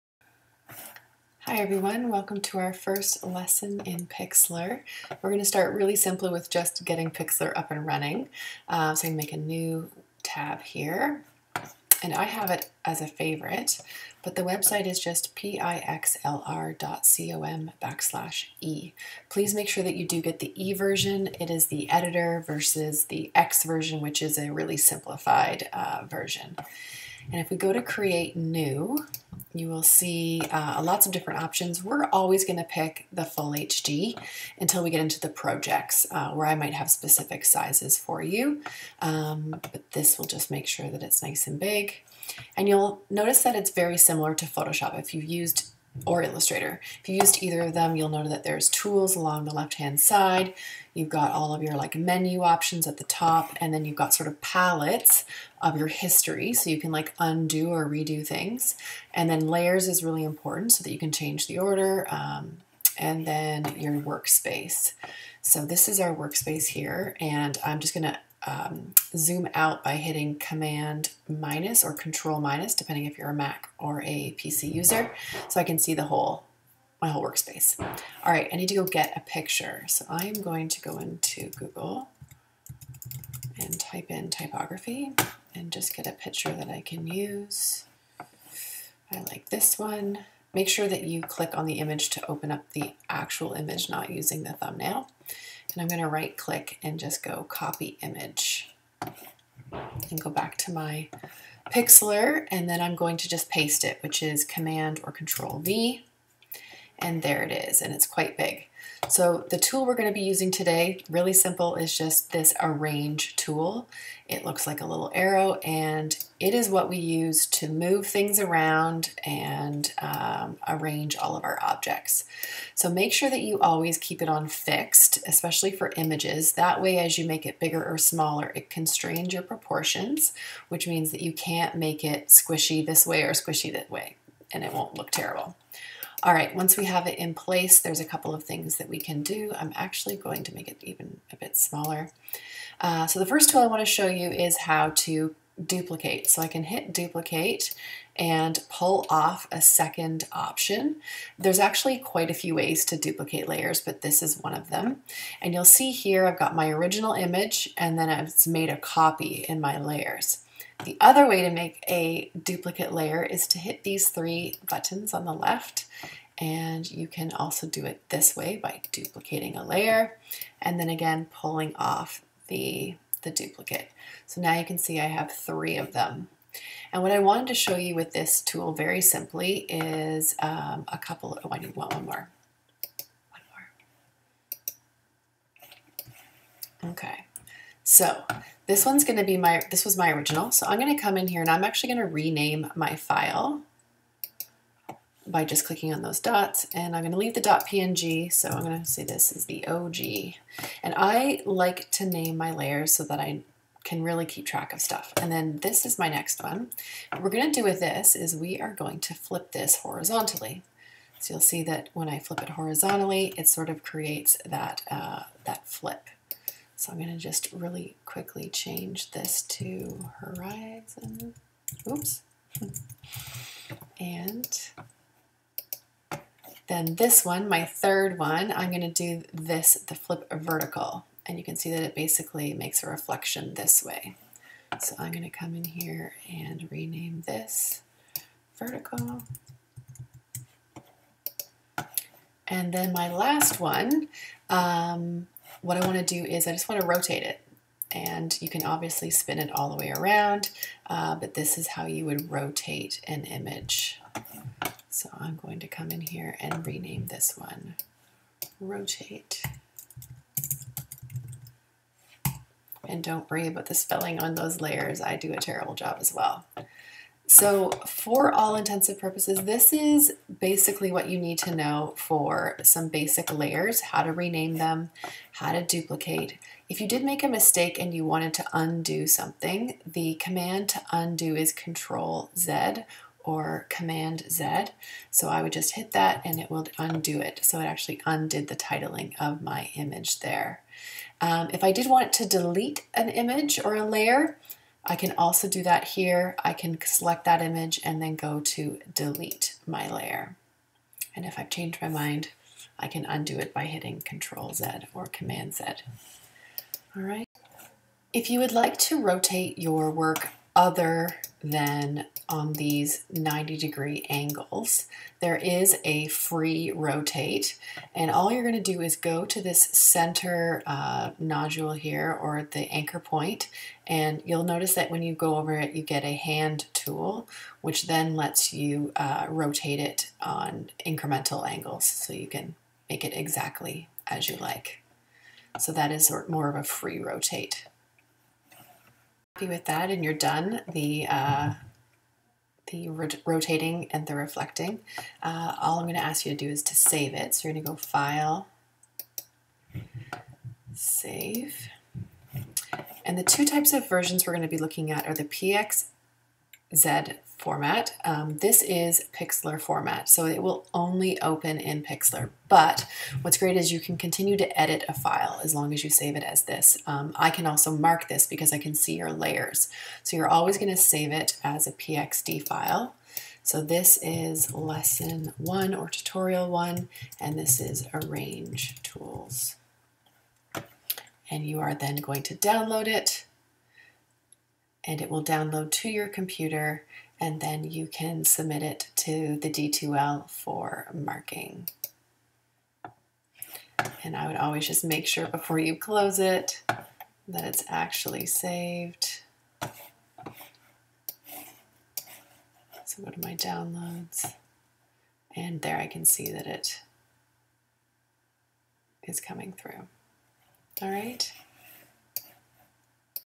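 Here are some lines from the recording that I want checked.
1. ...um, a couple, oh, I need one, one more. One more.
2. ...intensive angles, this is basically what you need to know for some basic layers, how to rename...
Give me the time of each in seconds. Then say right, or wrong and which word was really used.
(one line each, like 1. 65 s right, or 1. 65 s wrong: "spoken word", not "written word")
1. 180 s right
2. 268 s wrong: "purposes", not "angles".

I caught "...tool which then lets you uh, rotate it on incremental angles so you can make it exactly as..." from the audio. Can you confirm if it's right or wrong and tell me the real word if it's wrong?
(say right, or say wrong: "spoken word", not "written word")
right.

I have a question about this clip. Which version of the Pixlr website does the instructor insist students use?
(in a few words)
e version.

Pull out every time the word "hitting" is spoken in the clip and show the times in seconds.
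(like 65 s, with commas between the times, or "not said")
69 s, 303 s.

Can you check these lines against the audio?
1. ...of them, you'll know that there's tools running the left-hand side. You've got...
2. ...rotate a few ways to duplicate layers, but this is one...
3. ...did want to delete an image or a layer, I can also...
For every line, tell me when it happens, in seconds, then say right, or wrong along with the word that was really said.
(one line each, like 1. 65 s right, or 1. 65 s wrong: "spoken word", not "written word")
1. 47 s wrong: "along", not "running"
2. 151 s wrong: "quite", not "rotate"
3. 291 s right.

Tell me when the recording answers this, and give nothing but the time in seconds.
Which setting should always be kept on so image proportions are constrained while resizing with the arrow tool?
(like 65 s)
124 s.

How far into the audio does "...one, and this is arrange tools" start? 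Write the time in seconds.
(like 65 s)
376 s.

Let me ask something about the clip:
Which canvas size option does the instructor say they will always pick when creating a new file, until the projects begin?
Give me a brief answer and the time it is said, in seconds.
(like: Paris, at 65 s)
full HD, at 33 s.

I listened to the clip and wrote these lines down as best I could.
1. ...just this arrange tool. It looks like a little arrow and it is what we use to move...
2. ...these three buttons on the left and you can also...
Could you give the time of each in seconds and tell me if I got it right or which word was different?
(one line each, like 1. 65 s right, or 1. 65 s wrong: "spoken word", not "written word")
1. 111 s right
2. 163 s right.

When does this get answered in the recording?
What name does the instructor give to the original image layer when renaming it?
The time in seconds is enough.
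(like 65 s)
199 s.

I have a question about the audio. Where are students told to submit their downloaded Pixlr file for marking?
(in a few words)
D2L.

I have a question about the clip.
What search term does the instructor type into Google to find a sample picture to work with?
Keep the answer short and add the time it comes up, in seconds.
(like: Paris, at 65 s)
typography, at 84 s.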